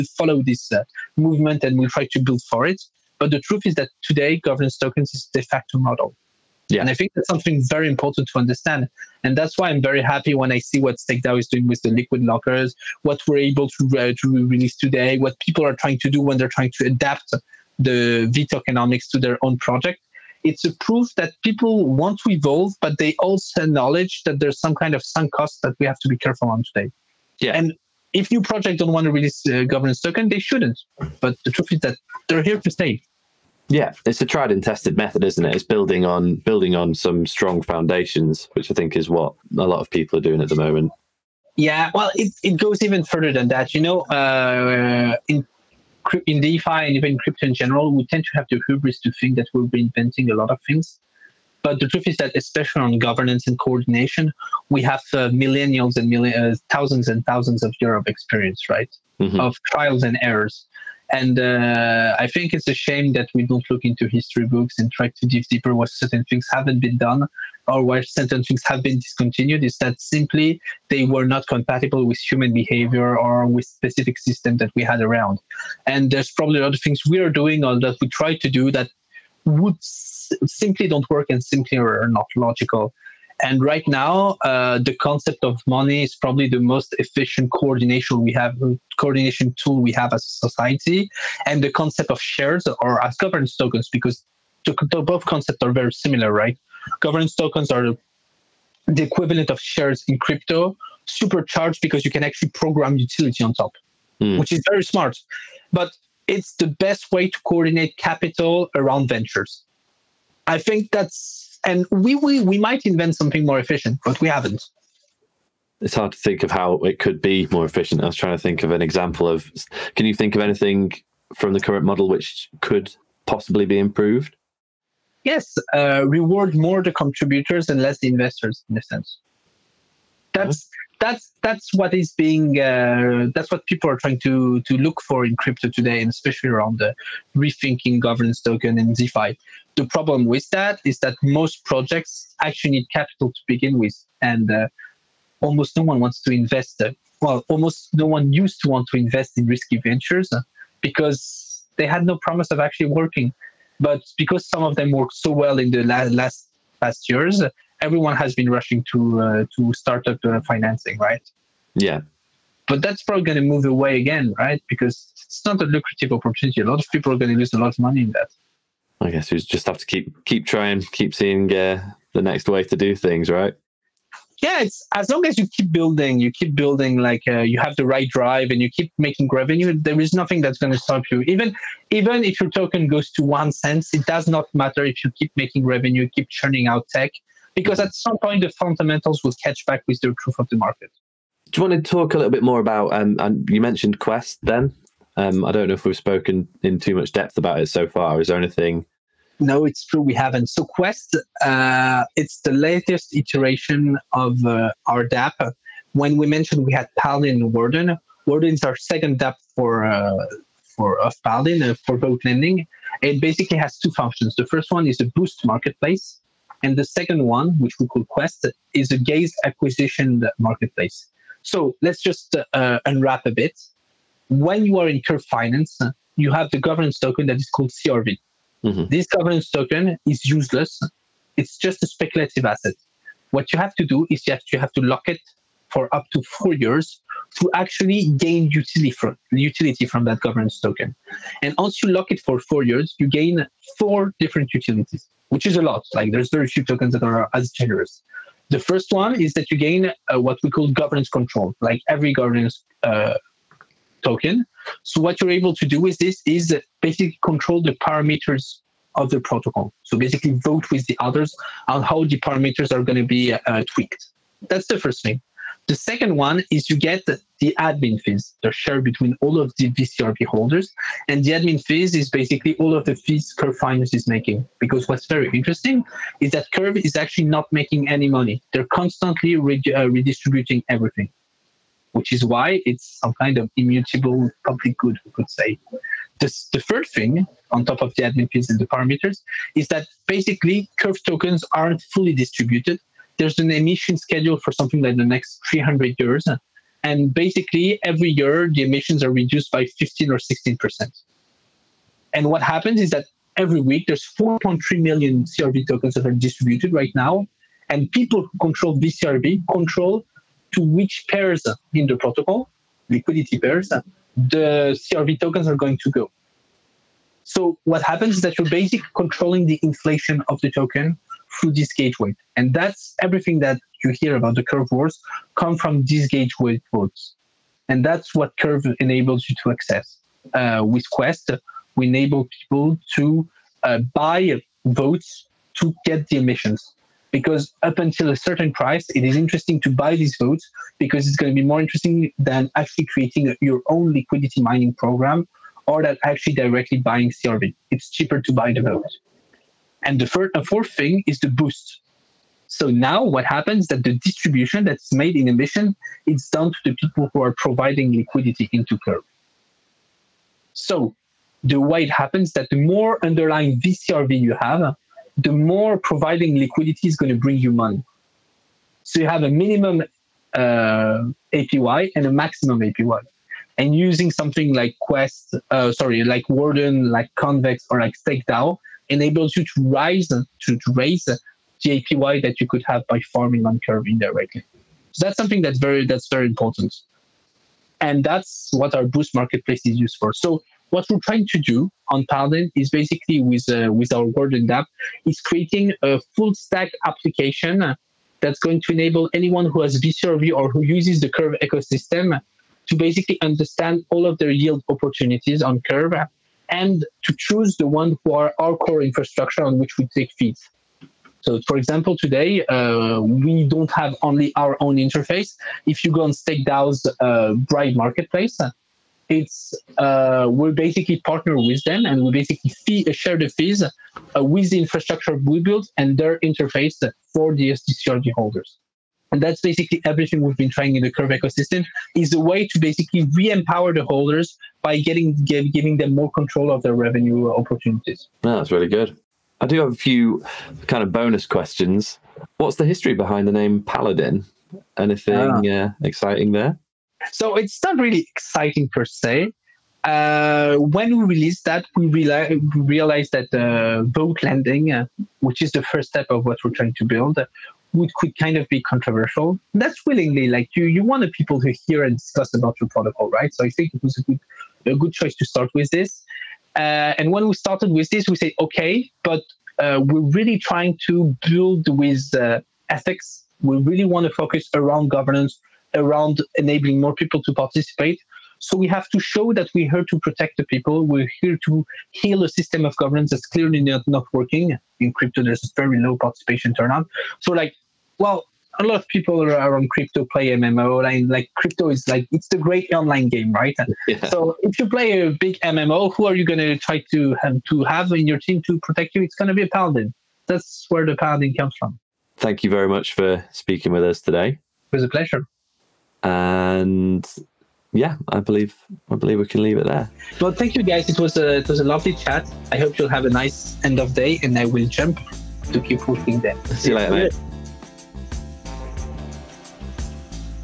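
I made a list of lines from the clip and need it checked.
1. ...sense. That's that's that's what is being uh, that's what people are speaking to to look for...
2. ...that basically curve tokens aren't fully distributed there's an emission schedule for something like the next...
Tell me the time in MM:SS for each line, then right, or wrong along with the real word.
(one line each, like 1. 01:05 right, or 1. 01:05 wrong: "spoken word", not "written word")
1. 02:08 wrong: "trying", not "speaking"
2. 04:49 right.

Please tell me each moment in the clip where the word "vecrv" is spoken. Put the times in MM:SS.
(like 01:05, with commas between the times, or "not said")
04:29, 05:08, 06:03, 06:39.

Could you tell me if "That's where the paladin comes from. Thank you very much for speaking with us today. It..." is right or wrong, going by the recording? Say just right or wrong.
right.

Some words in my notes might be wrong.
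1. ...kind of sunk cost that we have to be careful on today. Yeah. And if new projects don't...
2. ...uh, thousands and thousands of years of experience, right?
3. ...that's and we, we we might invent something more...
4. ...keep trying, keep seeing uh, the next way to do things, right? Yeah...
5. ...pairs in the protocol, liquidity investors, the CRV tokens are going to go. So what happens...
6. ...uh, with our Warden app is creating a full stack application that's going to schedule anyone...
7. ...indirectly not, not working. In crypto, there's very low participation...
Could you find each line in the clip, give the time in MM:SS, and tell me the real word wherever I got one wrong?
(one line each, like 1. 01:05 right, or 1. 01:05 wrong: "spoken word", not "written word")
1. 00:24 right
2. 00:56 right
3. 01:50 right
4. 02:50 right
5. 05:11 wrong: "pairs", not "investors"
6. 06:33 wrong: "enable", not "schedule"
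7. 08:03 wrong: "clearly", not "indirectly".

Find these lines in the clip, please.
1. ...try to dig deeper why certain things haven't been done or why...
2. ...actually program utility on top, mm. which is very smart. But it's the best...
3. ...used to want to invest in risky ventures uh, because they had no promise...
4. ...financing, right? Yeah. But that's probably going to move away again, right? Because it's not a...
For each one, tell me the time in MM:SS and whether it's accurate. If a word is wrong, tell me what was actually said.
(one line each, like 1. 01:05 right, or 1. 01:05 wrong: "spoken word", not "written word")
1. 01:04 right
2. 01:42 right
3. 02:28 right
4. 02:40 right.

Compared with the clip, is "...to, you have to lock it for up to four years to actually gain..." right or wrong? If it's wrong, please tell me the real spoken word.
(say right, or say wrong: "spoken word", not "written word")
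right.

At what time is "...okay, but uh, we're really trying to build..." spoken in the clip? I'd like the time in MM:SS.
07:48.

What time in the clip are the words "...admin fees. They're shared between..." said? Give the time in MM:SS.
04:27.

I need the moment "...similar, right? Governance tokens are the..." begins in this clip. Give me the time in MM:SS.
01:35.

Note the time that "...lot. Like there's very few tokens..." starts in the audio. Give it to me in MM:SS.
04:05.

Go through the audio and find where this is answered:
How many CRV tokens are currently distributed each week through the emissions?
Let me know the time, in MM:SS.
05:04.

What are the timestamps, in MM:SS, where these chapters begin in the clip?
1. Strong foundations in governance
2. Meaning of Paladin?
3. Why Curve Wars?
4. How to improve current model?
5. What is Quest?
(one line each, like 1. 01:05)
1. 00:33
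2. 07:22
3. 03:44
4. 01:59
5. 03:11.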